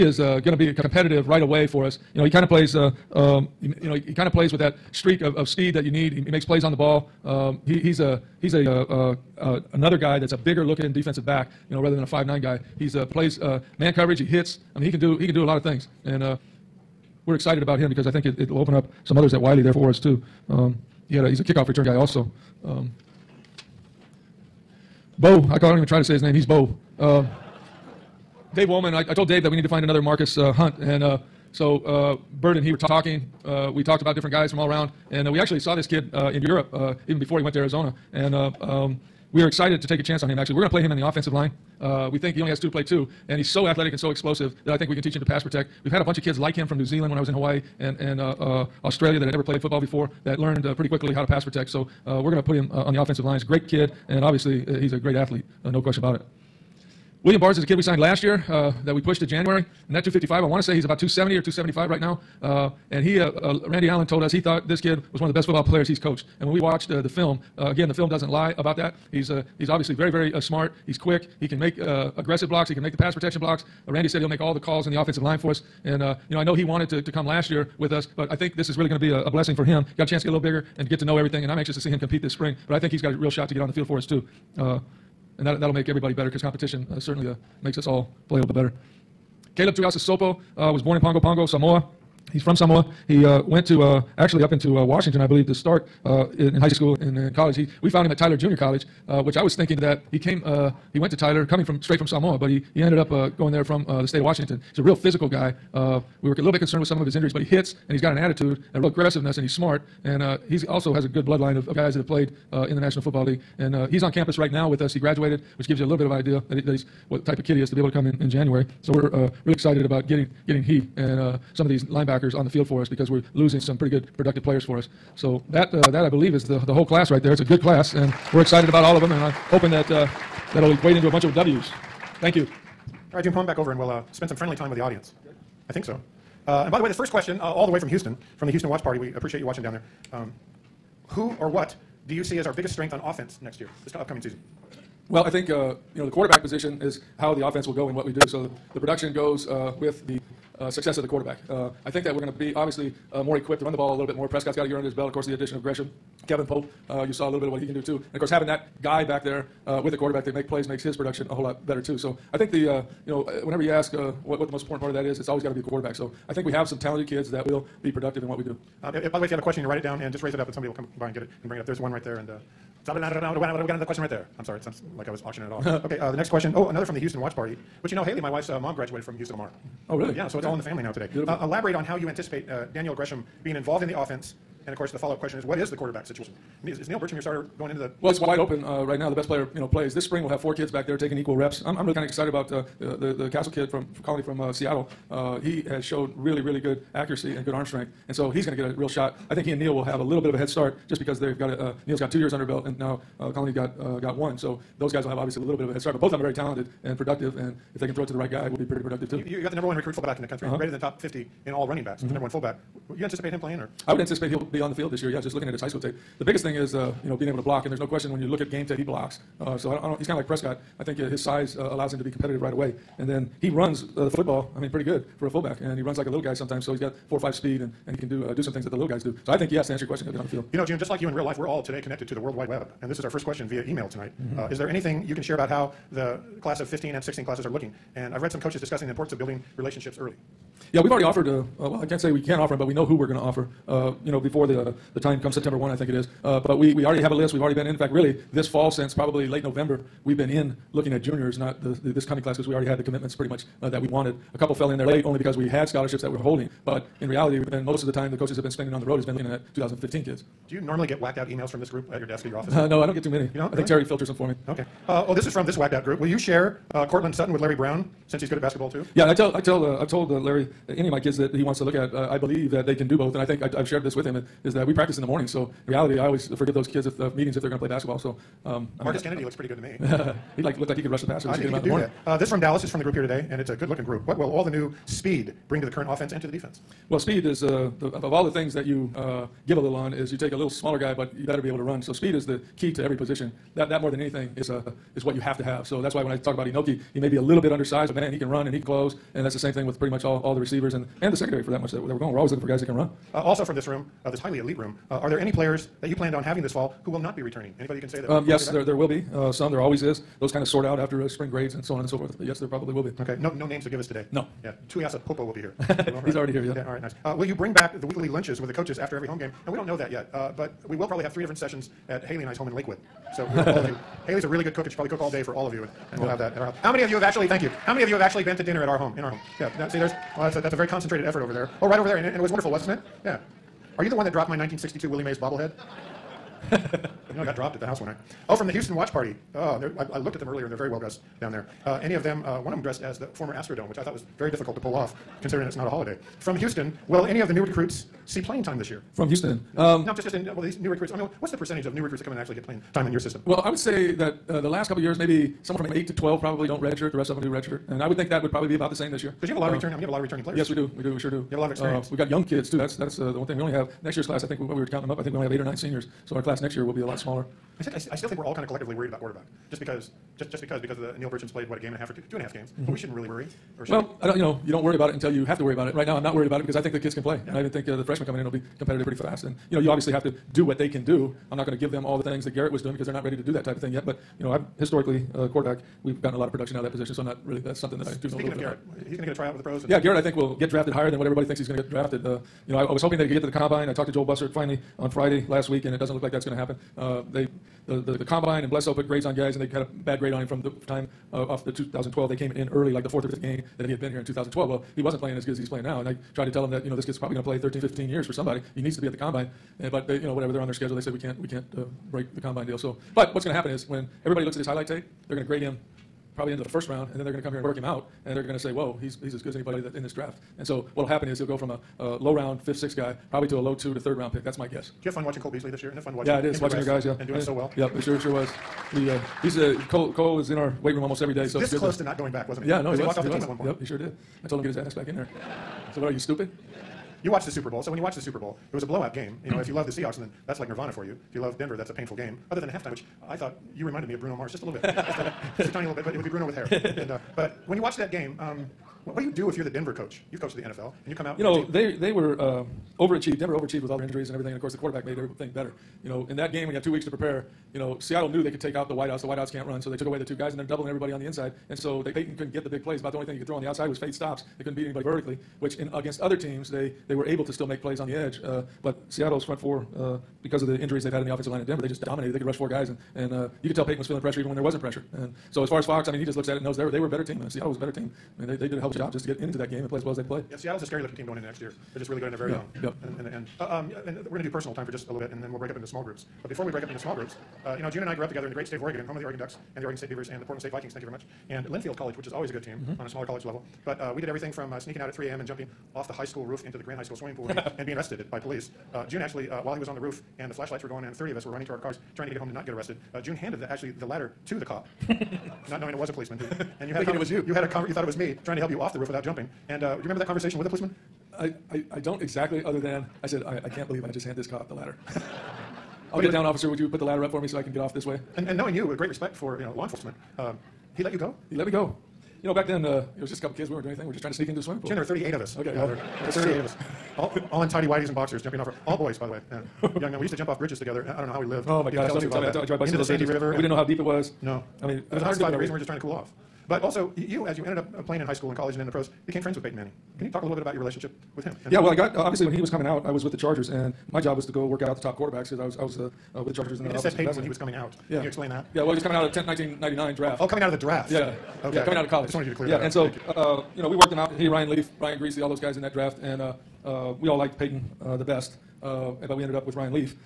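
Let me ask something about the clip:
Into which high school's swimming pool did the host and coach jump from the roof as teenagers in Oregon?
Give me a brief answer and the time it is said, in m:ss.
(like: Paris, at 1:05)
Grant High School, at 8:16.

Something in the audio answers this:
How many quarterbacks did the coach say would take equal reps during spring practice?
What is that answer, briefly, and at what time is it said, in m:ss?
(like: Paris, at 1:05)
4, at 3:10.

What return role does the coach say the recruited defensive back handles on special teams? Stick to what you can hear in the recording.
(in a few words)
Kickoff return.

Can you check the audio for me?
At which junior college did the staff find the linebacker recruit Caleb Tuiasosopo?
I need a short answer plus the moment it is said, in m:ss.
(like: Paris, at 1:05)
Tyler Junior College, at 1:38.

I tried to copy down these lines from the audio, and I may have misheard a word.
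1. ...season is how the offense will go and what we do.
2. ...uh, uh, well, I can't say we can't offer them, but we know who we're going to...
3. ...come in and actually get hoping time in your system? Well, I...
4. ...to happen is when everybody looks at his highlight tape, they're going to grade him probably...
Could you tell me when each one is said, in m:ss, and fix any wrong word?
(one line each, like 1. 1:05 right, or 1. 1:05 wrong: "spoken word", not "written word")
1. 2:26 wrong: "position", not "season"
2. 4:01 right
3. 5:52 wrong: "playing", not "hoping"
4. 6:53 right.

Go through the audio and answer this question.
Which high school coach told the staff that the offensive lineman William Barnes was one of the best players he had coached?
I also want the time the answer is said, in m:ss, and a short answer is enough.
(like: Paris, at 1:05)
Randy Allen, at 1:03.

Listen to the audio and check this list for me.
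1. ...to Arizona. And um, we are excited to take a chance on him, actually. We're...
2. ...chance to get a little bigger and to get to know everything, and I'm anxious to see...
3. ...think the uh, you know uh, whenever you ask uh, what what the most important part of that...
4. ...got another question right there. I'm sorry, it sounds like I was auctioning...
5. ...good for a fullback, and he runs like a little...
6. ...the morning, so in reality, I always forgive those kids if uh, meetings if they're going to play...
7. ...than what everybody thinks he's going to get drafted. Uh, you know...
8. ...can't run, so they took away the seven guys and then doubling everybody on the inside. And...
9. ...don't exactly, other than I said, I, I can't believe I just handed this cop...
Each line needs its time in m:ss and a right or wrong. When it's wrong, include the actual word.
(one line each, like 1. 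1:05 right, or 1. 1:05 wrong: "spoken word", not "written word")
1. 0:37 right
2. 1:20 right
3. 2:42 right
4. 2:53 right
5. 3:44 right
6. 4:35 right
7. 6:30 right
8. 7:39 wrong: "two", not "seven"
9. 8:31 right.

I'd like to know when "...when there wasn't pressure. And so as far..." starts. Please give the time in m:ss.
7:54.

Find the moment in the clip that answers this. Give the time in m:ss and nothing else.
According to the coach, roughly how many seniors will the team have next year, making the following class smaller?
6:05.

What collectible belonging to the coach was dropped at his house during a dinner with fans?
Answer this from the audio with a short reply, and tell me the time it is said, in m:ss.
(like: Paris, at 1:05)
1962 Willie Mays bobblehead, at 5:34.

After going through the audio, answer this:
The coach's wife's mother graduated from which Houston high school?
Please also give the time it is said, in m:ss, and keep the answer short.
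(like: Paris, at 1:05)
Houston Lamar, at 2:59.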